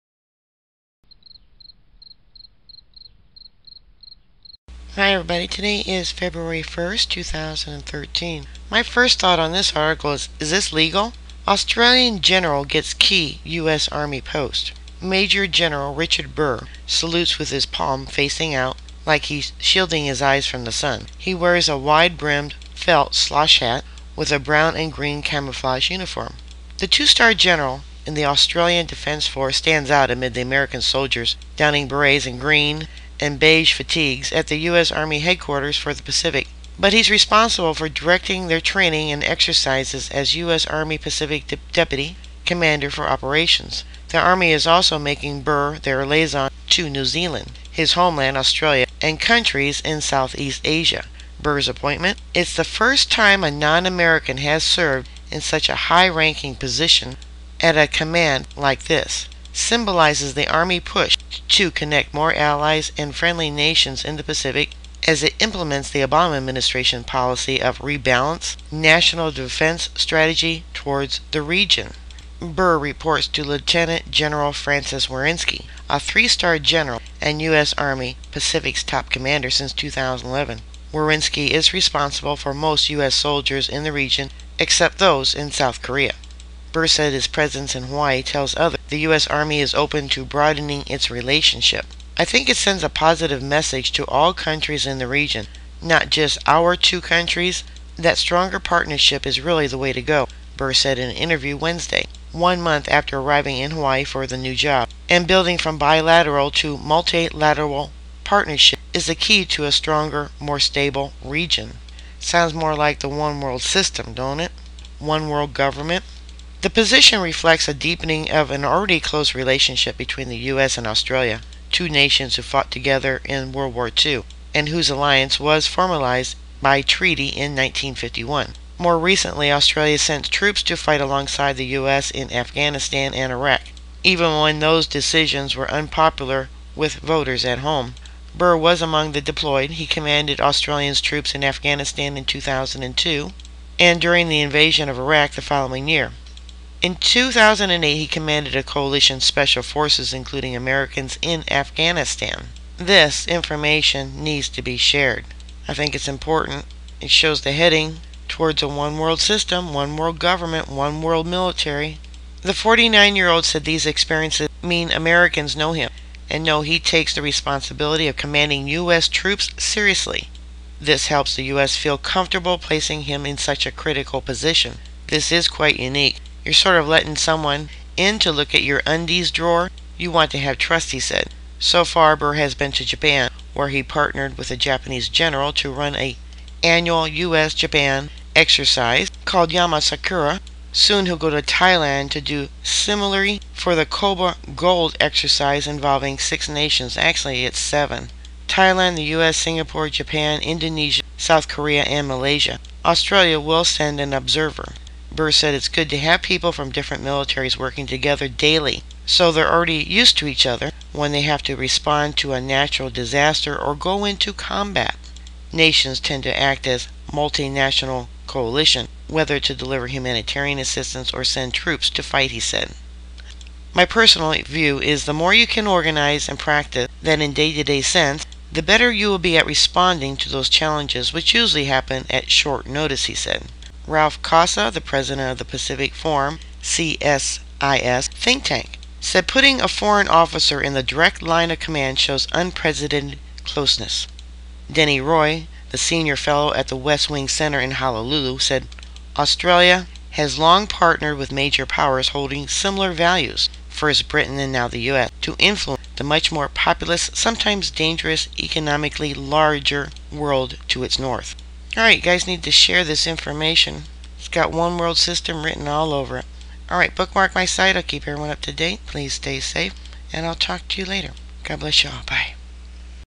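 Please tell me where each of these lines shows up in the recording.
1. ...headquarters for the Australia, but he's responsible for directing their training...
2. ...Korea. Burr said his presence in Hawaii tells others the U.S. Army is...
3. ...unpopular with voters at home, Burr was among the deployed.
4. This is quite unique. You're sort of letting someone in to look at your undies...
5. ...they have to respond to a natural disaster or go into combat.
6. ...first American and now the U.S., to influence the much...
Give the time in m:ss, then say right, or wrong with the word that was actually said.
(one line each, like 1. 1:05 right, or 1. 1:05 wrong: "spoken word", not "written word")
1. 0:35 wrong: "Pacific", not "Australia"
2. 1:25 right
3. 2:15 right
4. 2:55 right
5. 3:31 right
6. 4:13 wrong: "Britain", not "American".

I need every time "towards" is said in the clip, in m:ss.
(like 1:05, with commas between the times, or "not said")
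1:10, 2:38.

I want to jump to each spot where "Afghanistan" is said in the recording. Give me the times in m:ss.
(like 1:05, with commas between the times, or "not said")
2:12, 2:21, 2:31.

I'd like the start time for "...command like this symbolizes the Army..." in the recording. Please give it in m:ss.
0:57.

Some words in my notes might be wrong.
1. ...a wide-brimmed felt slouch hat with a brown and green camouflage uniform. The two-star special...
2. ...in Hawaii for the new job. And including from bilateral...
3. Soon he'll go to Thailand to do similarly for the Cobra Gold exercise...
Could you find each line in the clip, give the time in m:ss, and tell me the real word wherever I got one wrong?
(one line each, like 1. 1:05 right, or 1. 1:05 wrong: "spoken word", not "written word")
1. 0:21 wrong: "general", not "special"
2. 1:43 wrong: "building", not "including"
3. 3:10 right.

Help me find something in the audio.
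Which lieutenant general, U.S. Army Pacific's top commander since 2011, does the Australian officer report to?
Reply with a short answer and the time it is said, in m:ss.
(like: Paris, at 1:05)
Francis Wiercinski, at 1:14.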